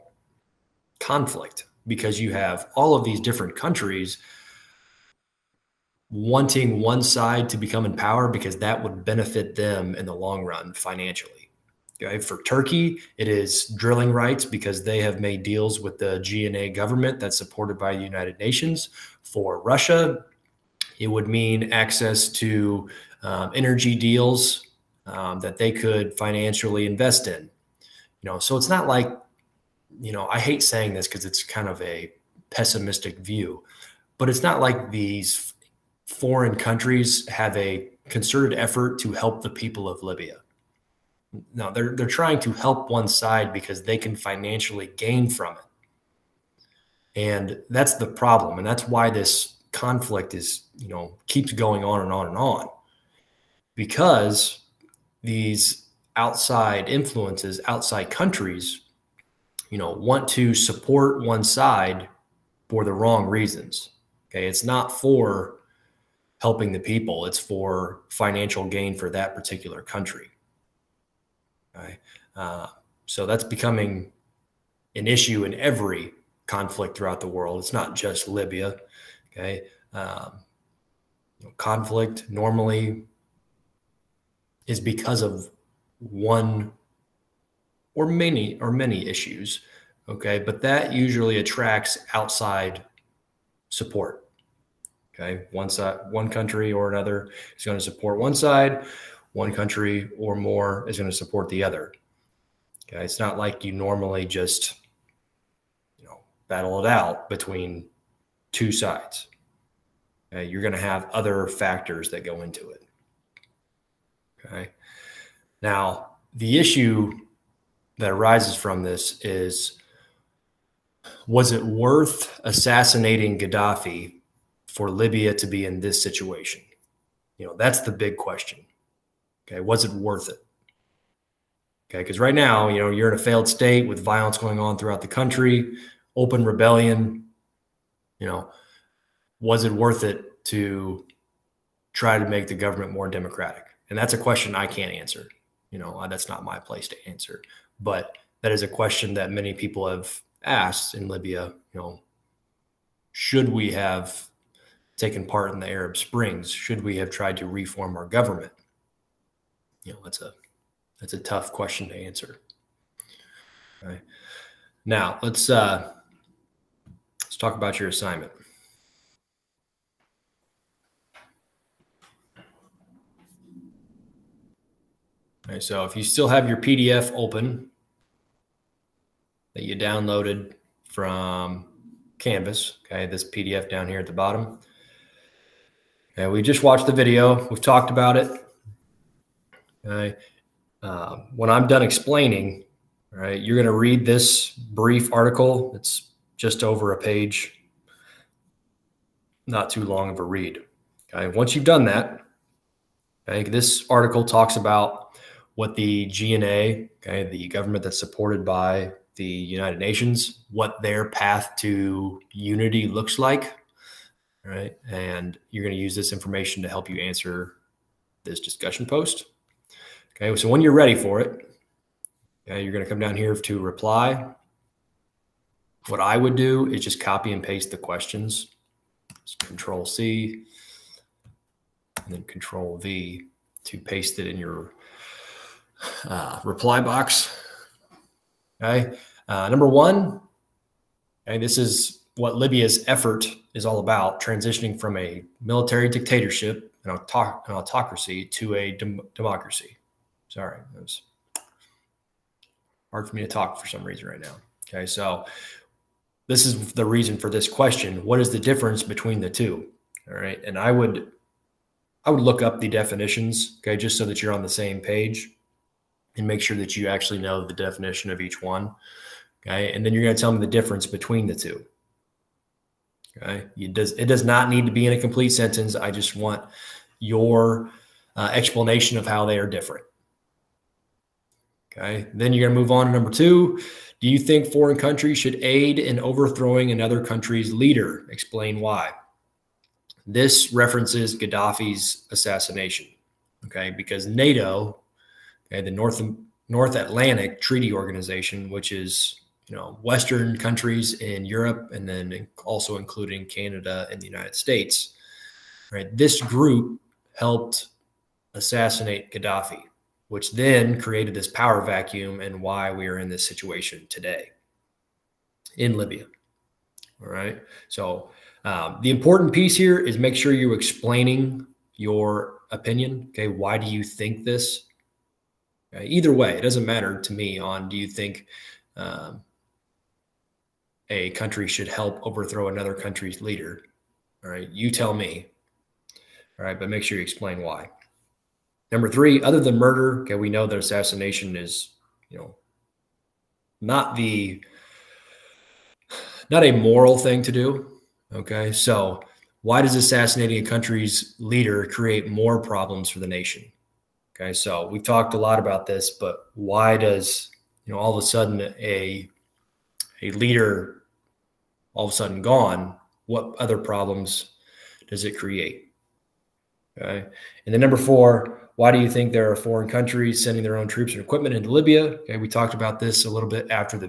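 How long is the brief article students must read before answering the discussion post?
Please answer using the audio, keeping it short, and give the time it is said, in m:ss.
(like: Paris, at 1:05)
Just over a page, at 3:16.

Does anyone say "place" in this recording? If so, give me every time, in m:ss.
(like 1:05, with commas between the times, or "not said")
2:26.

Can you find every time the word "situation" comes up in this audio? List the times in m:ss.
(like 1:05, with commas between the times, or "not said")
2:06, 5:13.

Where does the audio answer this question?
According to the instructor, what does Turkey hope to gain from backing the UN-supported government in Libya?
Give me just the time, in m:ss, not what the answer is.
0:13.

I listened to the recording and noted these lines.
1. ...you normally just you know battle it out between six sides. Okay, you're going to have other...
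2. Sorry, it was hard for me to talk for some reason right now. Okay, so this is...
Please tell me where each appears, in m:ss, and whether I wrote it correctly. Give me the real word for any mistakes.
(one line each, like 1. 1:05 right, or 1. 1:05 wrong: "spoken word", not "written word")
1. 1:43 wrong: "two", not "six"
2. 4:10 right.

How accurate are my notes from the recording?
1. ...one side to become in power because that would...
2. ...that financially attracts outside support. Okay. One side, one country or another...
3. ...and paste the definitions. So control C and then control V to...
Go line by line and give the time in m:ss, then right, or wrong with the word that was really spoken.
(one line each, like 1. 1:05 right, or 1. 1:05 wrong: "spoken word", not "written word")
1. 0:06 right
2. 1:30 wrong: "usually", not "financially"
3. 3:47 wrong: "questions", not "definitions".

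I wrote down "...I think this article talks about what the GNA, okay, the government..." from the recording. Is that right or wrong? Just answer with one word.
right.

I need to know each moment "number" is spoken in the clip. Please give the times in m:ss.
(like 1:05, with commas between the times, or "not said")
3:59, 4:42, 5:38, 6:07.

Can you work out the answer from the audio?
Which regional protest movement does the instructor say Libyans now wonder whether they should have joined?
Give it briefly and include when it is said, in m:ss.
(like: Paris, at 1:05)
Arab Springs, at 2:35.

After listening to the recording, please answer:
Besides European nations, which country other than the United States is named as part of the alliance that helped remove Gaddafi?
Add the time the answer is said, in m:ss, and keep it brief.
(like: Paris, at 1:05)
Canada, at 5:03.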